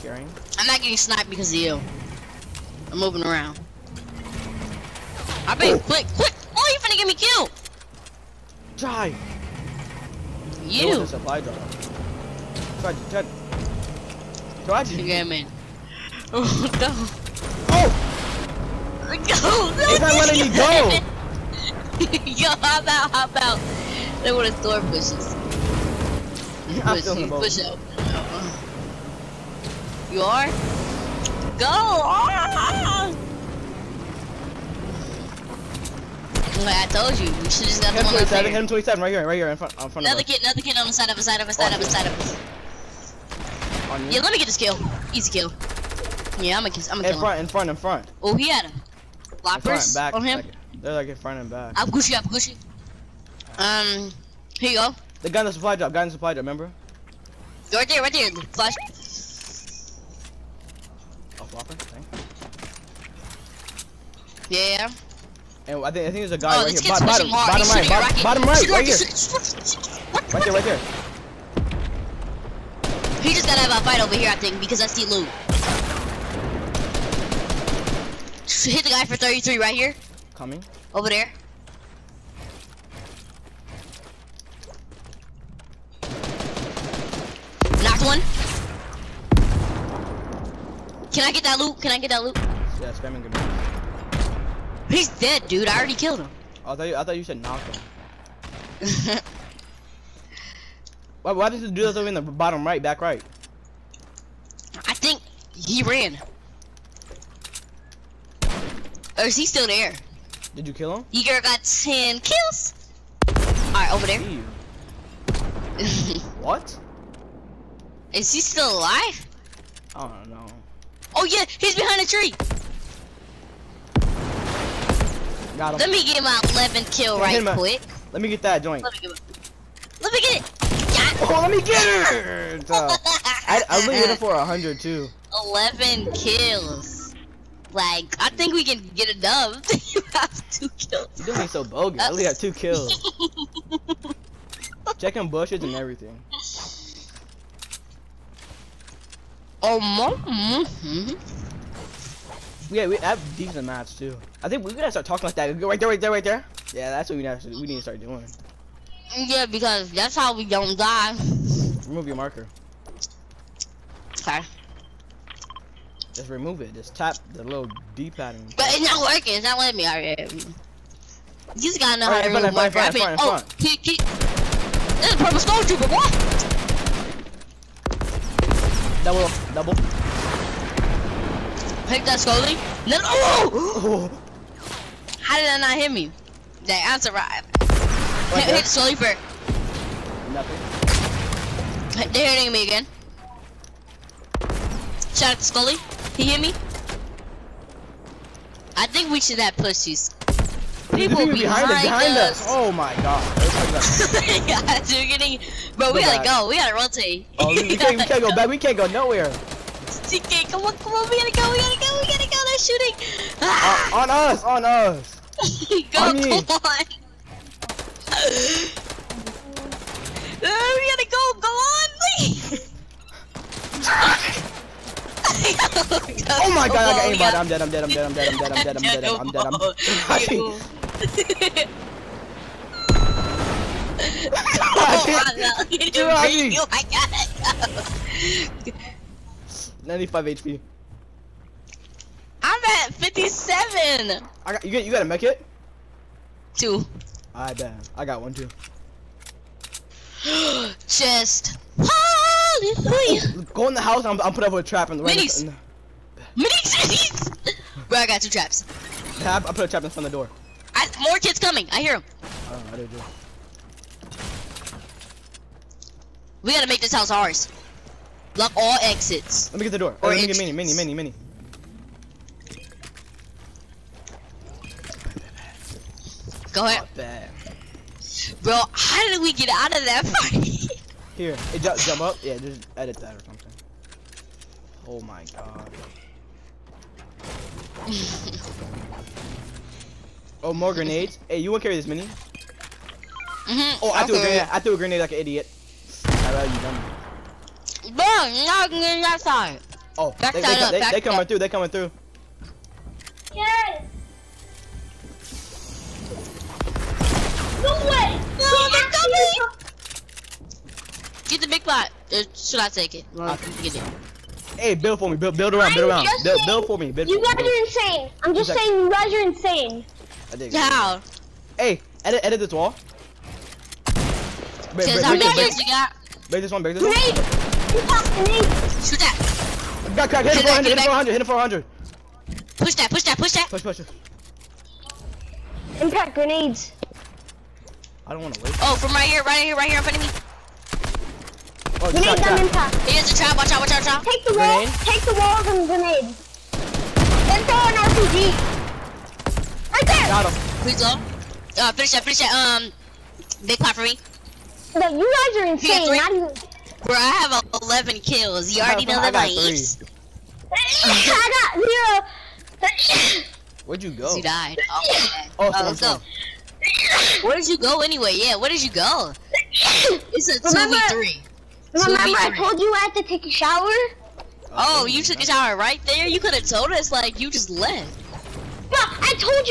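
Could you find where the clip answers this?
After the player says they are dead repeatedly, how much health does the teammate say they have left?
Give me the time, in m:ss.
4:02.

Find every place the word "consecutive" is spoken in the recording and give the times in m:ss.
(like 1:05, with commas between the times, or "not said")
not said.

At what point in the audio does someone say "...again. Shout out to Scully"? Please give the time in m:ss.
3:12.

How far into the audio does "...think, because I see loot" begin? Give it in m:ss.
1:14.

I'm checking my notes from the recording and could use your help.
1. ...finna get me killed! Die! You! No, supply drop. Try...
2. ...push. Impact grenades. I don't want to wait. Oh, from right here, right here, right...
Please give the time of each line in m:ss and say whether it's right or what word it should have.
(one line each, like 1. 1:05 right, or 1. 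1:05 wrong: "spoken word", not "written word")
1. 0:06 right
2. 5:33 right.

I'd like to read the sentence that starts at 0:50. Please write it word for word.
Like, they're like in front and back.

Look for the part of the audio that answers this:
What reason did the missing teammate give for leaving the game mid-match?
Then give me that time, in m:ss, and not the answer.
6:13.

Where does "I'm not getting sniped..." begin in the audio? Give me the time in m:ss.
0:00.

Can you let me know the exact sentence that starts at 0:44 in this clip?
Yeah, let me get this kill.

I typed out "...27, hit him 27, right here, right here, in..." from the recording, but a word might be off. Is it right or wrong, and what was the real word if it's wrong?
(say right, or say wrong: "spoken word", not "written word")
right.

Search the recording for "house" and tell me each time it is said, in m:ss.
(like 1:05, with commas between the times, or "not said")
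4:13, 4:26.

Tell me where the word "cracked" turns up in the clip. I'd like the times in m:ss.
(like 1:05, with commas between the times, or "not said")
5:30.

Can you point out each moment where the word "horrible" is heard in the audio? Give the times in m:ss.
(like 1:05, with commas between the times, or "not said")
not said.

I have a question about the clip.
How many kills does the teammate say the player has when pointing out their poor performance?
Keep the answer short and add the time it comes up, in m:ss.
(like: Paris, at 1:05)
2, at 2:19.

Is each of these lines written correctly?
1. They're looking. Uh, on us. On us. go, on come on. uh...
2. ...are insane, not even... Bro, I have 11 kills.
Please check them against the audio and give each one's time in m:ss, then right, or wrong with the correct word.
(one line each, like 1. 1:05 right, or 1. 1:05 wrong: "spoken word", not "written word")
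1. 3:32 wrong: "shooting", not "looking"
2. 5:55 right.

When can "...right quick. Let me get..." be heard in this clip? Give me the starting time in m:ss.
2:07.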